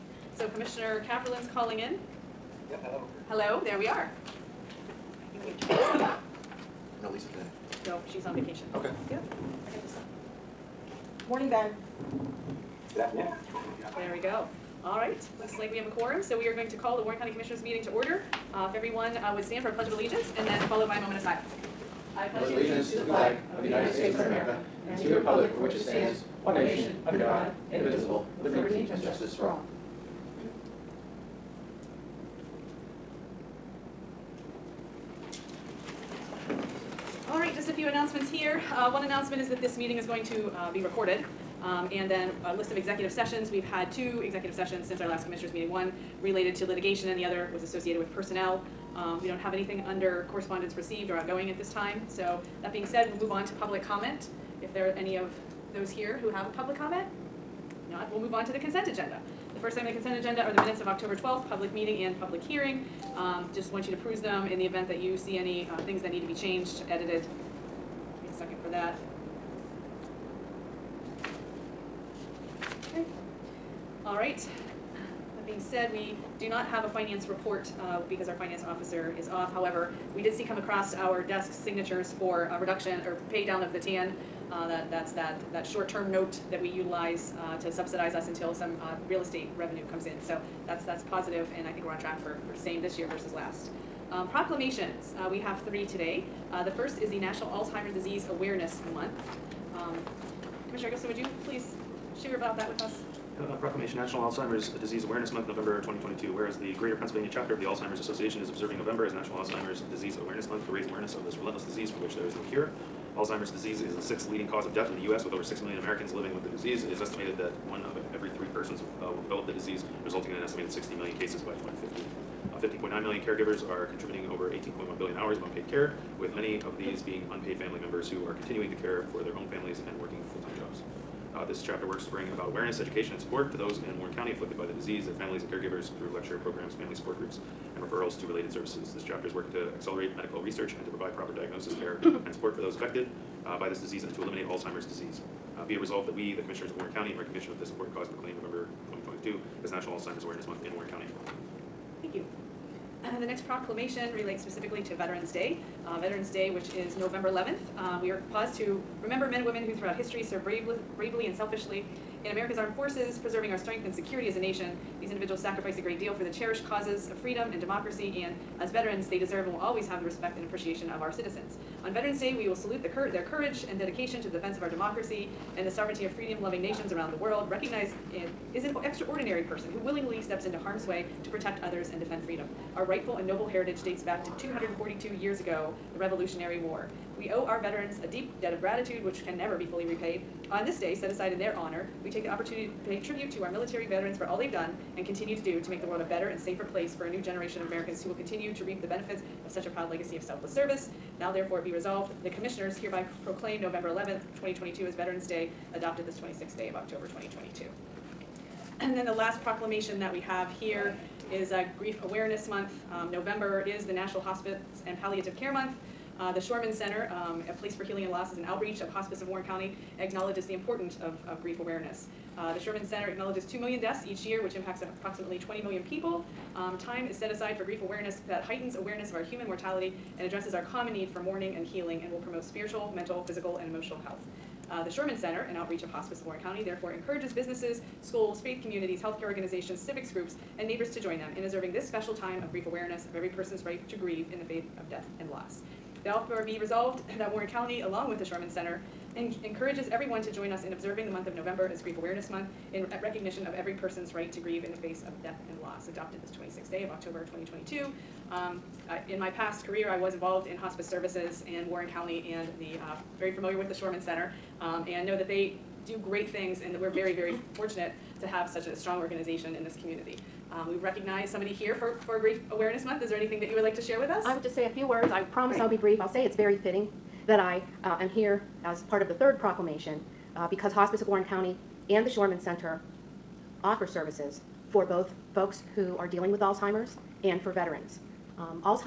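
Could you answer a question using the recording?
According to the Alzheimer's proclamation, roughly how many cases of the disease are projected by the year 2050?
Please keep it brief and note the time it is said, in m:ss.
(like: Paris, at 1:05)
16 million, at 2:00.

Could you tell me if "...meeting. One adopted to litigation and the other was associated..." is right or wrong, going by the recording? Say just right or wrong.
wrong.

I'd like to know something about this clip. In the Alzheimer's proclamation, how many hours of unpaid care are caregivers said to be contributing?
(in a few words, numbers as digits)
18.1 billion.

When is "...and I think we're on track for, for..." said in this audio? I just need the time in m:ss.
1:31.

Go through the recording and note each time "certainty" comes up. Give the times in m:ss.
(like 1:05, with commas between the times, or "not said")
not said.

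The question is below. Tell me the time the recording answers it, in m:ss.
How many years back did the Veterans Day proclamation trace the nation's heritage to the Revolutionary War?
3:04.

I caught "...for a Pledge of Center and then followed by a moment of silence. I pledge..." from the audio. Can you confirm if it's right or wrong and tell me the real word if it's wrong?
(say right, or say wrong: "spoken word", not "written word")
wrong: "Allegiance", not "Center".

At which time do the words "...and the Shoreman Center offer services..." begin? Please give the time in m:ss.
4:41.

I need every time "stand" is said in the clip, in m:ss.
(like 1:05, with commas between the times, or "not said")
0:19, 0:25.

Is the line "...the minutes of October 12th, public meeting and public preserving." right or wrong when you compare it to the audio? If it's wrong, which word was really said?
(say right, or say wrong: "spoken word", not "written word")
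wrong: "hearing", not "preserving".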